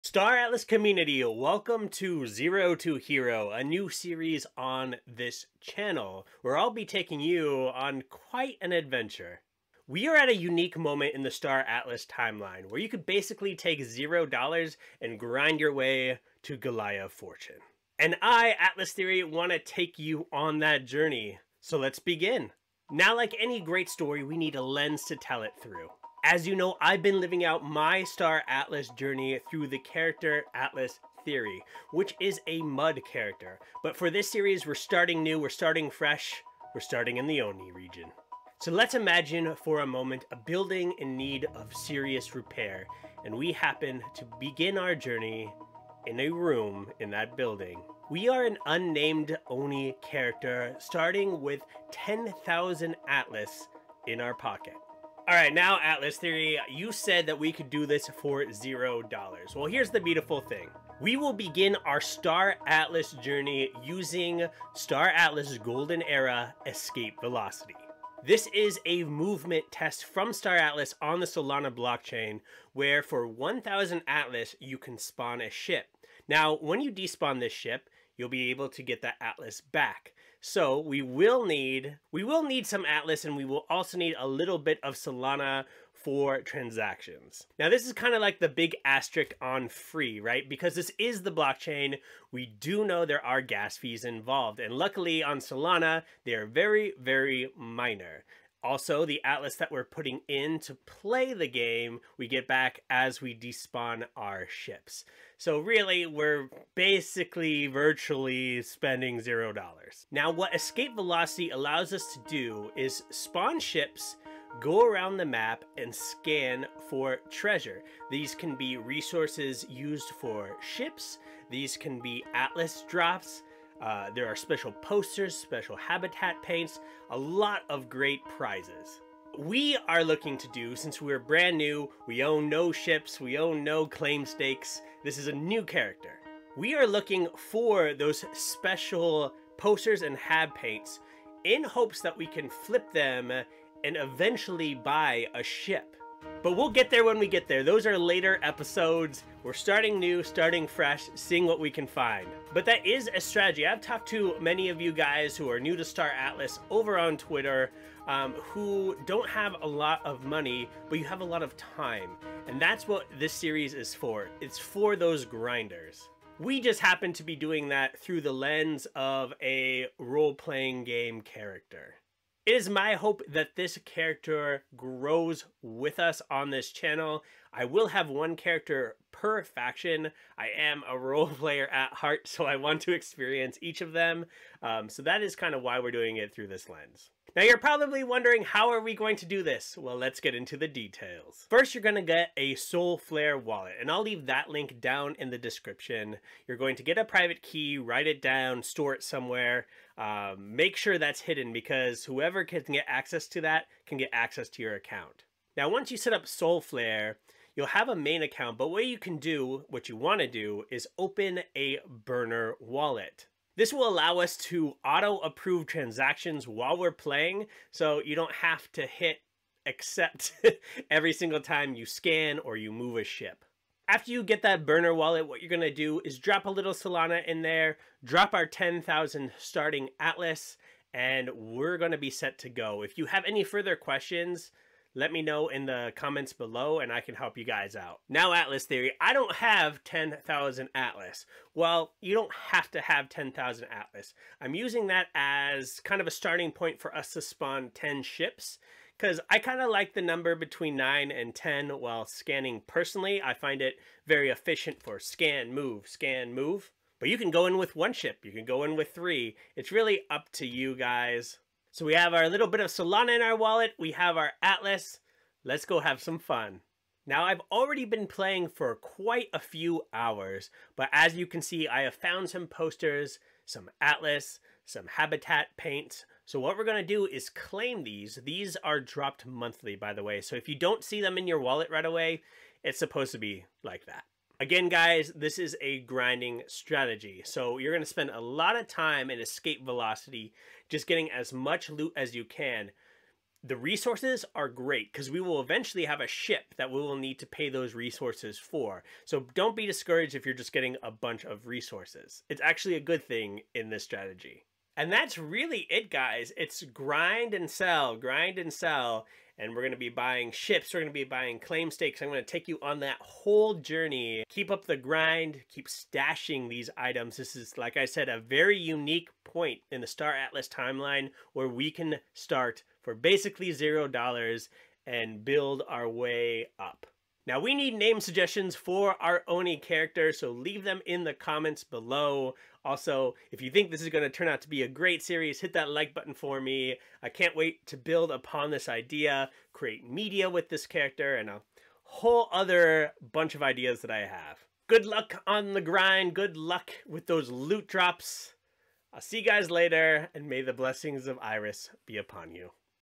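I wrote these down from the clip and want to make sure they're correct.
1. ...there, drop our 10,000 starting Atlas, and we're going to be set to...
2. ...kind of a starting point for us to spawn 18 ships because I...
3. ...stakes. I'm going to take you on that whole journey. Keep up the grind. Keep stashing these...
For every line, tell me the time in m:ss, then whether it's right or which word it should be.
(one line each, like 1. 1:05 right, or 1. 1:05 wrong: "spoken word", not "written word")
1. 3:47 right
2. 4:05 wrong: "10", not "18"
3. 5:11 right.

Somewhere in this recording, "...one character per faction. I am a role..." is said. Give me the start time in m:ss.
2:58.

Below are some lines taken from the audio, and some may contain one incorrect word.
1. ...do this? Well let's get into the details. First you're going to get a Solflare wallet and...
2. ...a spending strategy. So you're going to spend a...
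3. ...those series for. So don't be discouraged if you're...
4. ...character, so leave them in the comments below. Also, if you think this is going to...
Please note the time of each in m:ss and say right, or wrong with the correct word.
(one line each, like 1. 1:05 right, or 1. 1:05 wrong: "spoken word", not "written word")
1. 3:09 right
2. 4:45 wrong: "grinding", not "spending"
3. 4:57 wrong: "resources", not "series"
4. 5:29 right.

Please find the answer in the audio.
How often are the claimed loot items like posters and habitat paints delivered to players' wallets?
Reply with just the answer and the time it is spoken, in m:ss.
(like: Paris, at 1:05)
monthly, at 4:39.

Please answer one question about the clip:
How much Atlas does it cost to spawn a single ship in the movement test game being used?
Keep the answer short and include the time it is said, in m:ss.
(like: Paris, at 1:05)
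1000 Atlas, at 1:13.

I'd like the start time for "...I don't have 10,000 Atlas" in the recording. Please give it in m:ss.
3:58.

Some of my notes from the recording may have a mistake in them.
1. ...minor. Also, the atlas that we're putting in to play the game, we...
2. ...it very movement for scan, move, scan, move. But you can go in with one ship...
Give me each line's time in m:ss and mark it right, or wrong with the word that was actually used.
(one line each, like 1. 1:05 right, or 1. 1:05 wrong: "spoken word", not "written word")
1. 1:37 right
2. 4:13 wrong: "efficient", not "movement".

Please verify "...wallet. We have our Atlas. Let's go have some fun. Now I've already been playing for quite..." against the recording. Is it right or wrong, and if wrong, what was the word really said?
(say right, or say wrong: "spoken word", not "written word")
right.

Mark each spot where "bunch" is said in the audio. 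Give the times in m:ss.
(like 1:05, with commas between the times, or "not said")
5:00, 5:43.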